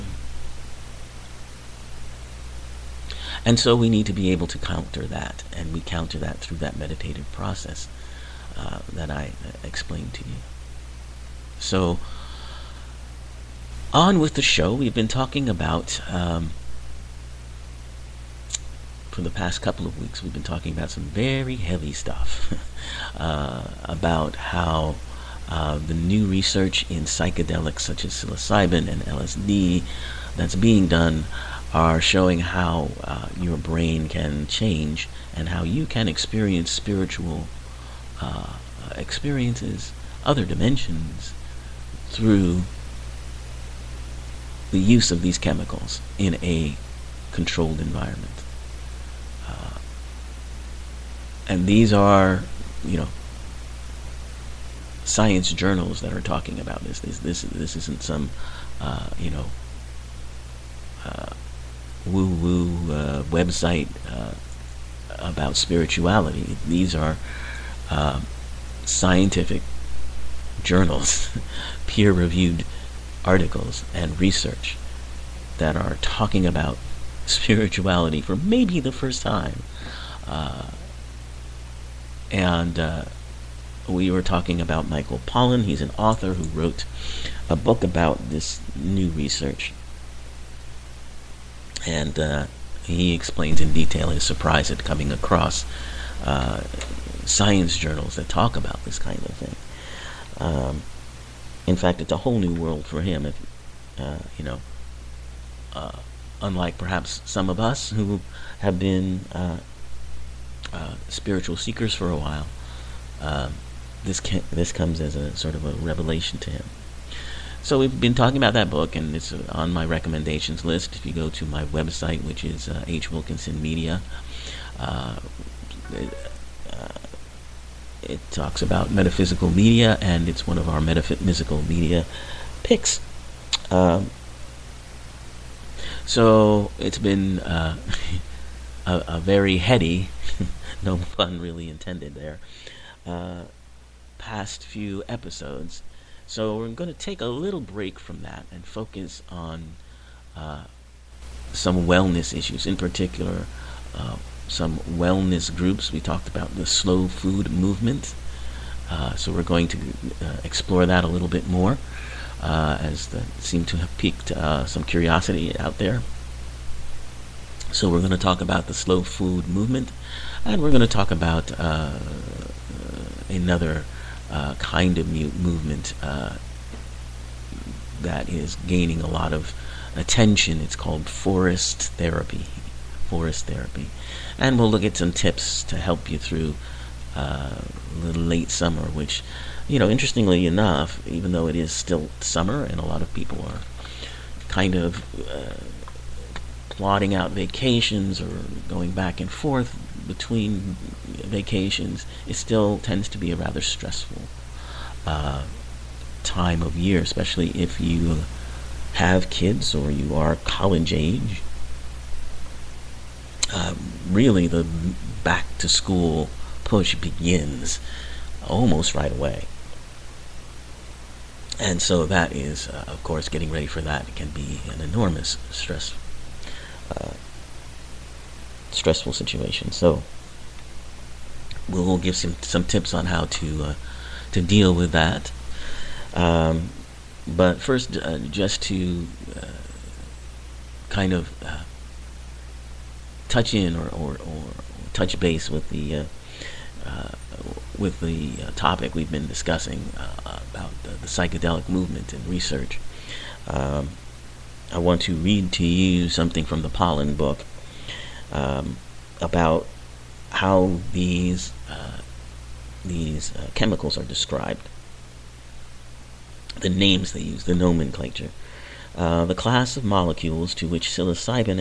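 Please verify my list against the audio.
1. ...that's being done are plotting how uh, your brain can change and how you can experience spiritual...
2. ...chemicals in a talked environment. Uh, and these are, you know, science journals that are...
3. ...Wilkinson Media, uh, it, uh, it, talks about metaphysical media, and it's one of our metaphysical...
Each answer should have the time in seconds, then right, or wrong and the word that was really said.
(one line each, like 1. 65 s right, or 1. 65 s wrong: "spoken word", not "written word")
1. 30 s wrong: "showing", not "plotting"
2. 45 s wrong: "controlled", not "talked"
3. 123 s right.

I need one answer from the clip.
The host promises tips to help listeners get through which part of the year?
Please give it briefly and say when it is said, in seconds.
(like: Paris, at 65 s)
late summer, at 188 s.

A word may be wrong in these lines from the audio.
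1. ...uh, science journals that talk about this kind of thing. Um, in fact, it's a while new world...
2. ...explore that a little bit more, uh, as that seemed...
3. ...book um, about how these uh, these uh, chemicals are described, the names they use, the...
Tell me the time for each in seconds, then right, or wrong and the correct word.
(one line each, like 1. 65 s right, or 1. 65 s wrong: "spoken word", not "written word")
1. 96 s wrong: "whole", not "while"
2. 160 s right
3. 257 s right.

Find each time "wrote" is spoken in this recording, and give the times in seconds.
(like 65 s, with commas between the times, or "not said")
86 s.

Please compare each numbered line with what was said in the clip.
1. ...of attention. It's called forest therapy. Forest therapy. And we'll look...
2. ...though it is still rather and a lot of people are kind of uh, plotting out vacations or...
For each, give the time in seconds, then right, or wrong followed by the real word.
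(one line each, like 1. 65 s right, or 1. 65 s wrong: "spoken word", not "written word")
1. 179 s right
2. 191 s wrong: "summer", not "rather".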